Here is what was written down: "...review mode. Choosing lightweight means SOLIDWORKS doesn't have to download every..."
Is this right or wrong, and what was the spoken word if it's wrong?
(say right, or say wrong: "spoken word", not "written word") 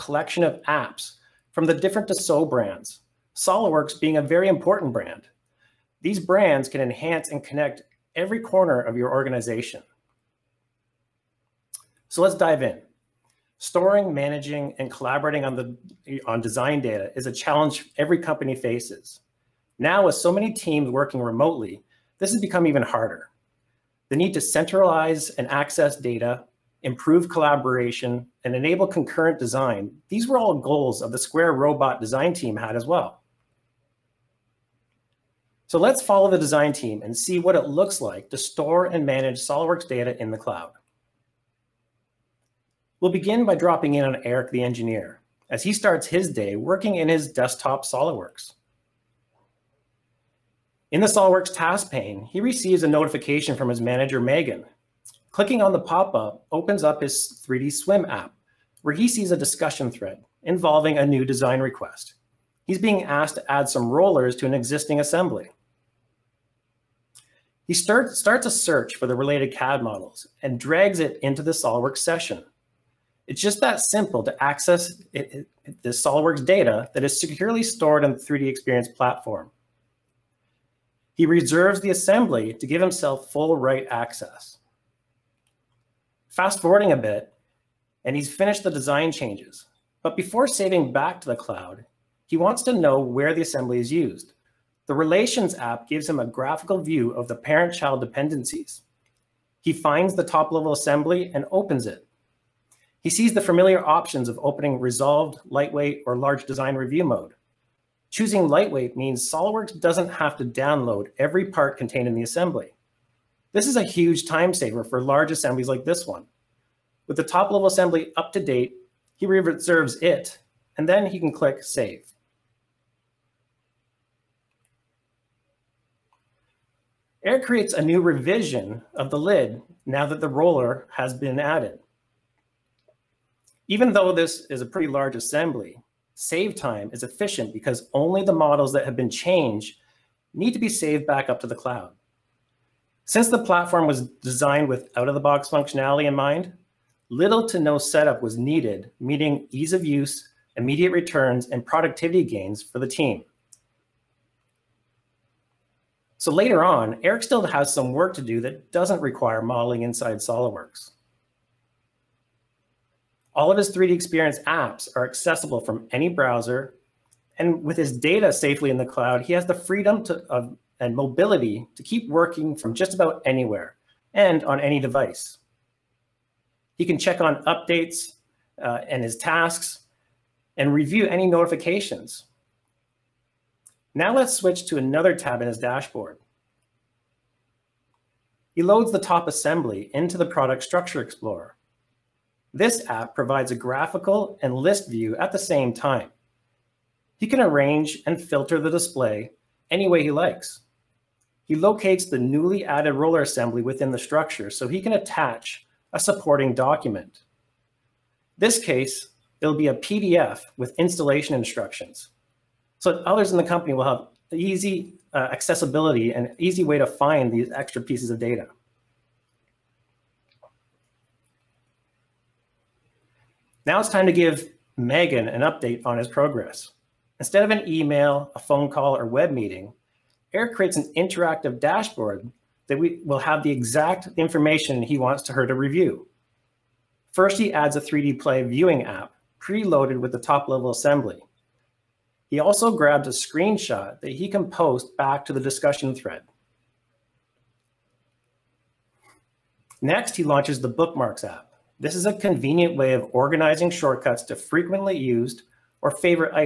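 right.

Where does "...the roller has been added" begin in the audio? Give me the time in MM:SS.
02:10.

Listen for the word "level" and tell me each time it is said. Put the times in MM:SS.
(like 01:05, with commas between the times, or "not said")
01:40, 01:57, 04:00.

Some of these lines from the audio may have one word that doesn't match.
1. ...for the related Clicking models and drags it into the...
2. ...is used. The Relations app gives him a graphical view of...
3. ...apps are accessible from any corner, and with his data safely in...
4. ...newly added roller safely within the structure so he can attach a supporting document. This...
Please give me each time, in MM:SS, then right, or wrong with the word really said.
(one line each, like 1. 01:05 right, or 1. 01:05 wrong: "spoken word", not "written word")
1. 01:08 wrong: "CAD", not "Clicking"
2. 01:33 right
3. 02:44 wrong: "browser", not "corner"
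4. 03:22 wrong: "assembly", not "safely".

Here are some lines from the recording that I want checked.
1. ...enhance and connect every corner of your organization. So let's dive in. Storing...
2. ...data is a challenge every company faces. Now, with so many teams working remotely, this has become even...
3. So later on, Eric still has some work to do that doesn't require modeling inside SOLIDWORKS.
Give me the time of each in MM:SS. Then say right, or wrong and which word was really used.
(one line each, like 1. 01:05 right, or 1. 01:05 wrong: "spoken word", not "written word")
1. 00:06 right
2. 00:16 right
3. 02:36 right.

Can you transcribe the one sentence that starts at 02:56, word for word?
He can check on updates uh, and his tasks and review any notifications.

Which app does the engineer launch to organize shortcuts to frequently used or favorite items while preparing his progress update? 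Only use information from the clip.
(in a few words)
Bookmarks.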